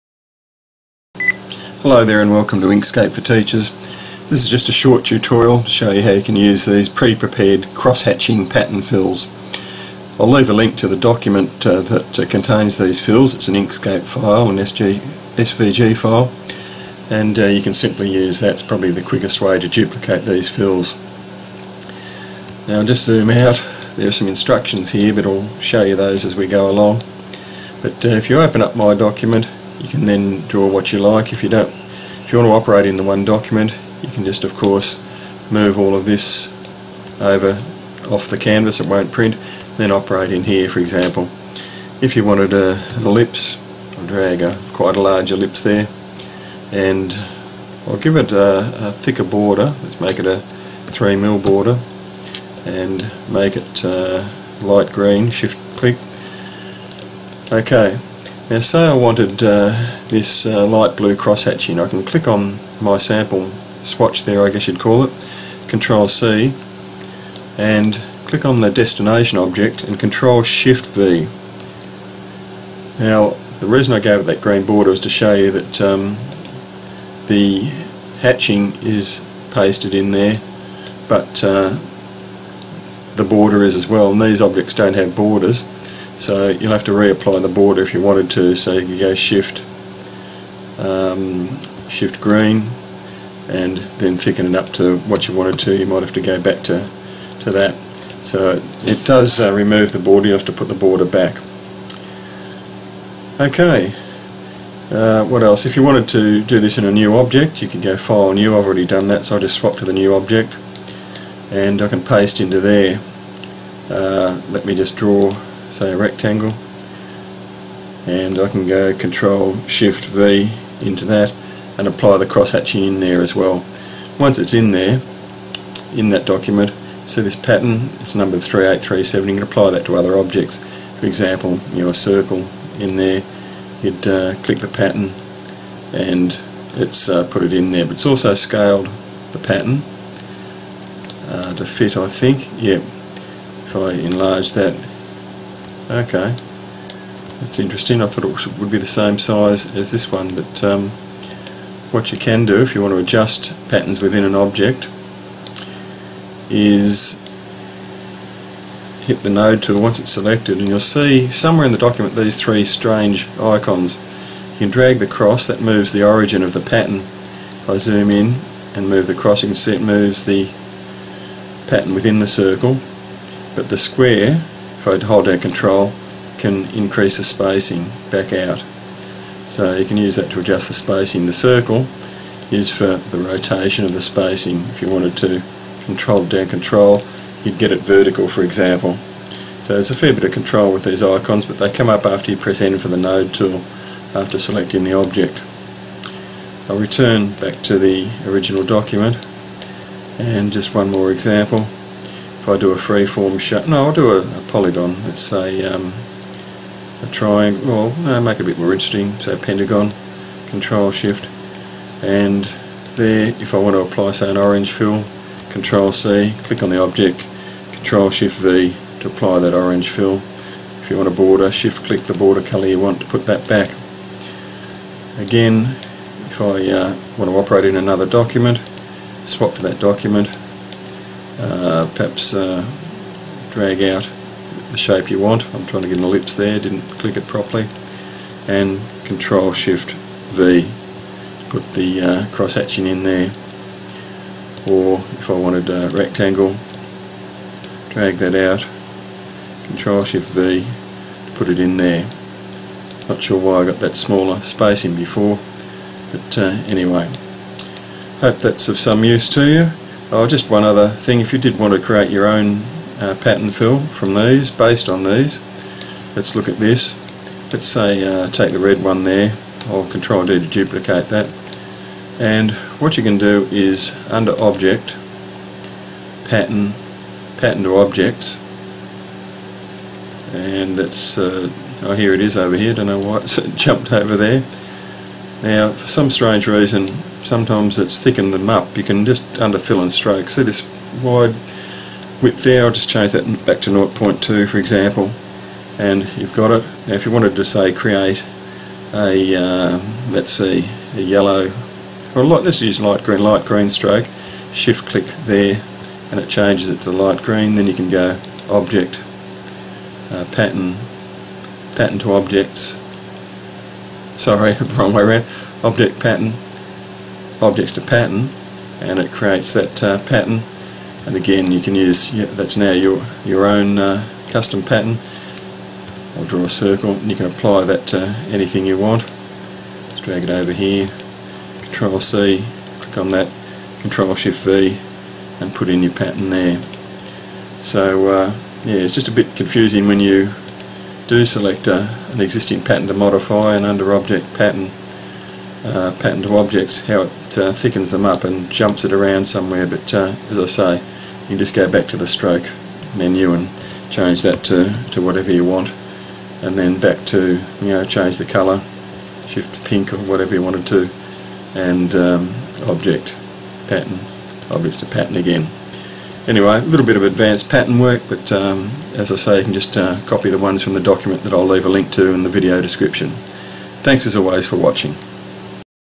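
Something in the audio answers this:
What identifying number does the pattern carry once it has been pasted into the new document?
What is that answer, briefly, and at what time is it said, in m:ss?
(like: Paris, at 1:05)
3837, at 2:08.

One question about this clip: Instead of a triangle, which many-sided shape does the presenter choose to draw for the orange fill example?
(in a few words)
pentagon.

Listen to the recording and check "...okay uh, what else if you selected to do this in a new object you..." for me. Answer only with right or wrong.
wrong.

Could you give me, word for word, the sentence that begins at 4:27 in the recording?
Let's say uh, take the red one there, or Control D to duplicate that.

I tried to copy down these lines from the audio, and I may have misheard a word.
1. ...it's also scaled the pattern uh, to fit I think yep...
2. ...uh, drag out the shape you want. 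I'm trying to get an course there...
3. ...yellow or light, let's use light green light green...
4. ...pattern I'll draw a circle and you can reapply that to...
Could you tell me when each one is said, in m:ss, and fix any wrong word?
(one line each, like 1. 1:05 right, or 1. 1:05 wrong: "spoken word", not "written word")
1. 2:17 right
2. 3:52 wrong: "ellipse", not "course"
3. 5:01 right
4. 5:24 wrong: "apply", not "reapply".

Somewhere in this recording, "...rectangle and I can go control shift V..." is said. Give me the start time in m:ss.
1:55.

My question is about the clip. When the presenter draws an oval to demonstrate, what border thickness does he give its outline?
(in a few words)
3 mil.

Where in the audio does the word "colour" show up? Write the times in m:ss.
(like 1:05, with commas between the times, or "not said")
3:42, 5:58.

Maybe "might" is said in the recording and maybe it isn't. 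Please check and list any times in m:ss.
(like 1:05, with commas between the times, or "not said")
1:35.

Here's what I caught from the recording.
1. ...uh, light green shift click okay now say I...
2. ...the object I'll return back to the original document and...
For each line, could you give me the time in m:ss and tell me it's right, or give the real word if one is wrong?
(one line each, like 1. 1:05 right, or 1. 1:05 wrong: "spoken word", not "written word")
1. 0:53 right
2. 3:14 right.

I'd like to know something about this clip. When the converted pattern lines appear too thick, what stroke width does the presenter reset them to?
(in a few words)
0.2.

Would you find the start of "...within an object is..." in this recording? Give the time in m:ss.
2:34.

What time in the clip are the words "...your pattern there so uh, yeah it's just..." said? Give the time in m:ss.
5:35.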